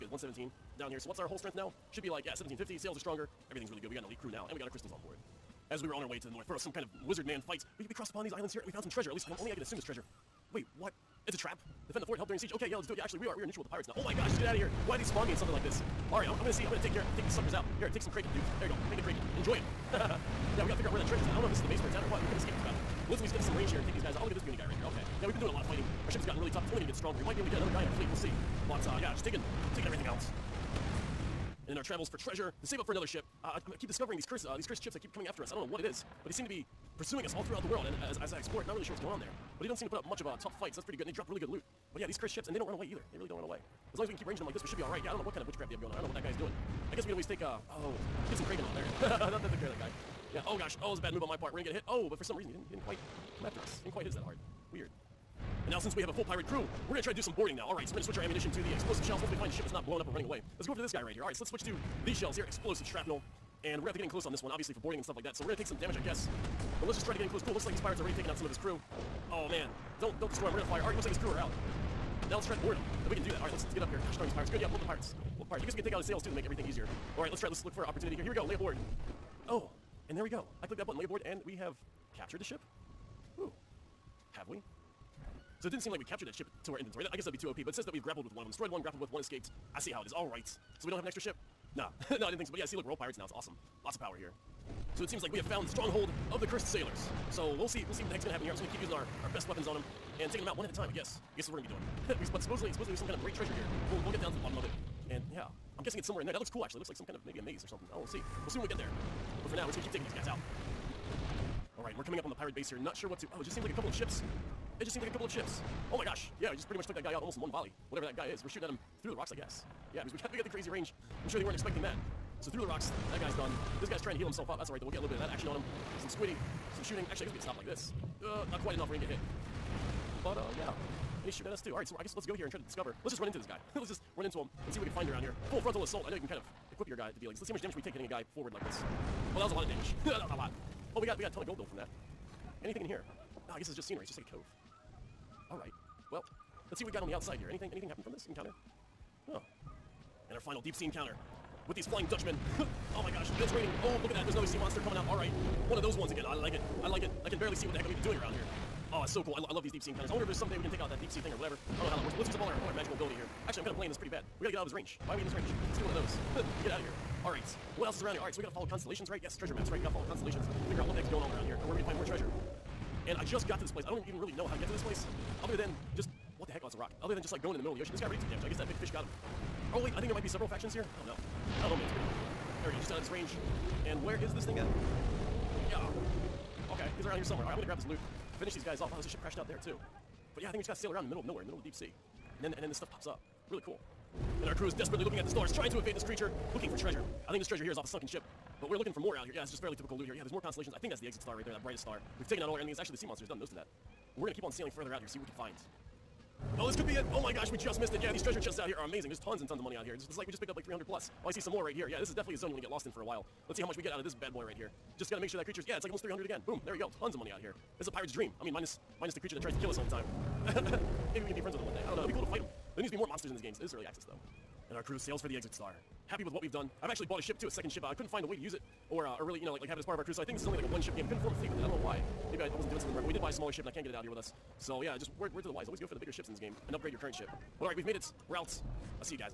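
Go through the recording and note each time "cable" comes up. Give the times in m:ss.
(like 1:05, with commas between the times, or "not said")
not said.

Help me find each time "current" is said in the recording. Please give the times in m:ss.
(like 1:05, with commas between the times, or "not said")
3:56.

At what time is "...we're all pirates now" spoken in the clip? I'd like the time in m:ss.
1:32.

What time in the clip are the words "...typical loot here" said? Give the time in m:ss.
3:19.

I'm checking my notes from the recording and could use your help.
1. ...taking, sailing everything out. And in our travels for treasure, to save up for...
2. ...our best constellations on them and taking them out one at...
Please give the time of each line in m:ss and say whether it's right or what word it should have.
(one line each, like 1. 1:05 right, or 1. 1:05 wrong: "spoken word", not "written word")
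1. 0:29 wrong: "taking", not "sailing"
2. 1:39 wrong: "weapons", not "constellations".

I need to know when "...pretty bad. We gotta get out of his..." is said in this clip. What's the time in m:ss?
2:43.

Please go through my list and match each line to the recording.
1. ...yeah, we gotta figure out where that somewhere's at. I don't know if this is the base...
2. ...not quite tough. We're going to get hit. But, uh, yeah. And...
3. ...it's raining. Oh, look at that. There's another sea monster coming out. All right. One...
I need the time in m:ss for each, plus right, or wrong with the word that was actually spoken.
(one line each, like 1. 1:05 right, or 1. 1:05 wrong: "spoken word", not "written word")
1. 0:20 wrong: "treasure", not "somewhere"
2. 2:08 wrong: "enough", not "tough"
3. 2:33 right.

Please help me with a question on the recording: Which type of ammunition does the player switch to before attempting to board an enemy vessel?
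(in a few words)
Explosive shrapnel.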